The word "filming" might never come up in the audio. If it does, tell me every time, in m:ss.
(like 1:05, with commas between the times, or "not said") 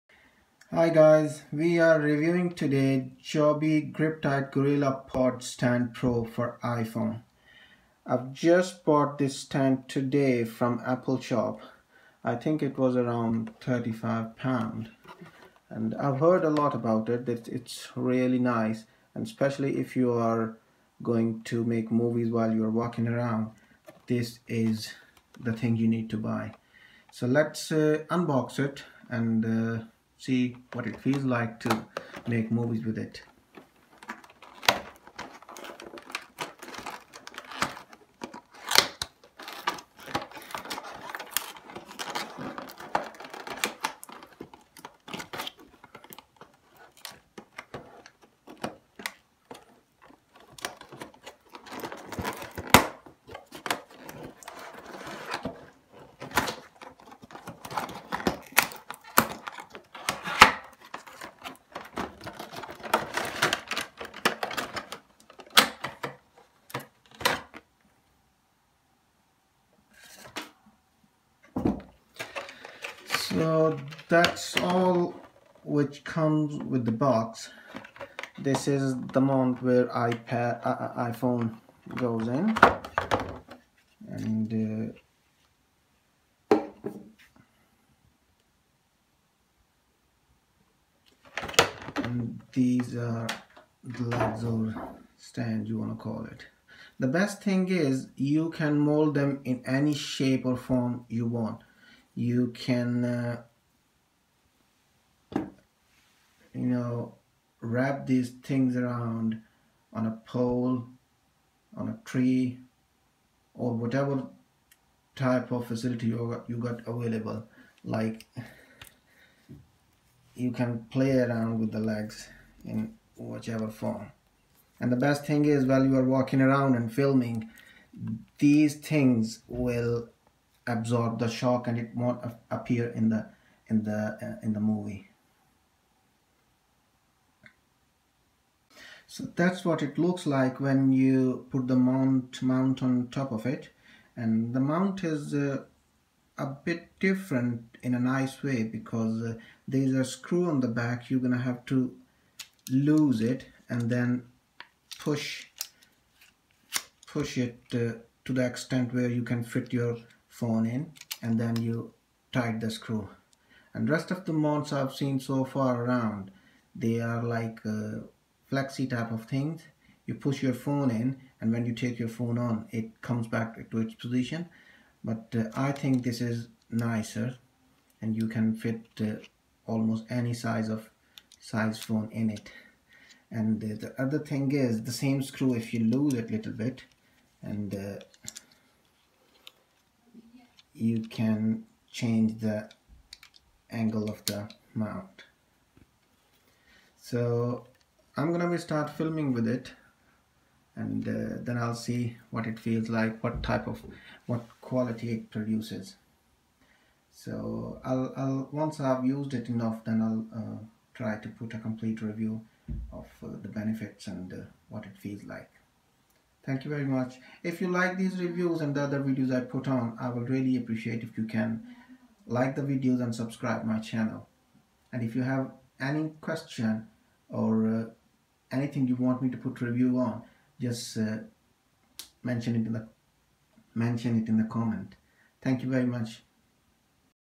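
2:06, 3:18.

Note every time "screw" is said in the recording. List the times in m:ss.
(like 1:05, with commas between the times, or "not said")
2:30, 2:42, 3:05.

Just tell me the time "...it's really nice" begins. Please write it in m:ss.
0:17.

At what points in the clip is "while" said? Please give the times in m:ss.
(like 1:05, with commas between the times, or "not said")
0:22, 2:05.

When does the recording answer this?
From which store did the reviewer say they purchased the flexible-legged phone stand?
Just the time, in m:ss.
0:10.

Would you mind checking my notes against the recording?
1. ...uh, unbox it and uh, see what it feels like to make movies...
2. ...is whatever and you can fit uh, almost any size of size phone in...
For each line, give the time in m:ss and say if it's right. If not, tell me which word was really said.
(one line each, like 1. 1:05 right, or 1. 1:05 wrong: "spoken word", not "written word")
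1. 0:27 right
2. 2:56 wrong: "nicer", not "whatever".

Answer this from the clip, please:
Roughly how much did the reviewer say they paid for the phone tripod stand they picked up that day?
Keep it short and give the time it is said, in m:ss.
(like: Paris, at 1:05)
35 pounds, at 0:13.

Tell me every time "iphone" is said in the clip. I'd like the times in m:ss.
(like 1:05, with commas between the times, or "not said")
0:06, 1:21.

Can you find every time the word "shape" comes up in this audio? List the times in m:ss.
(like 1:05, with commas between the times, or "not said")
1:39.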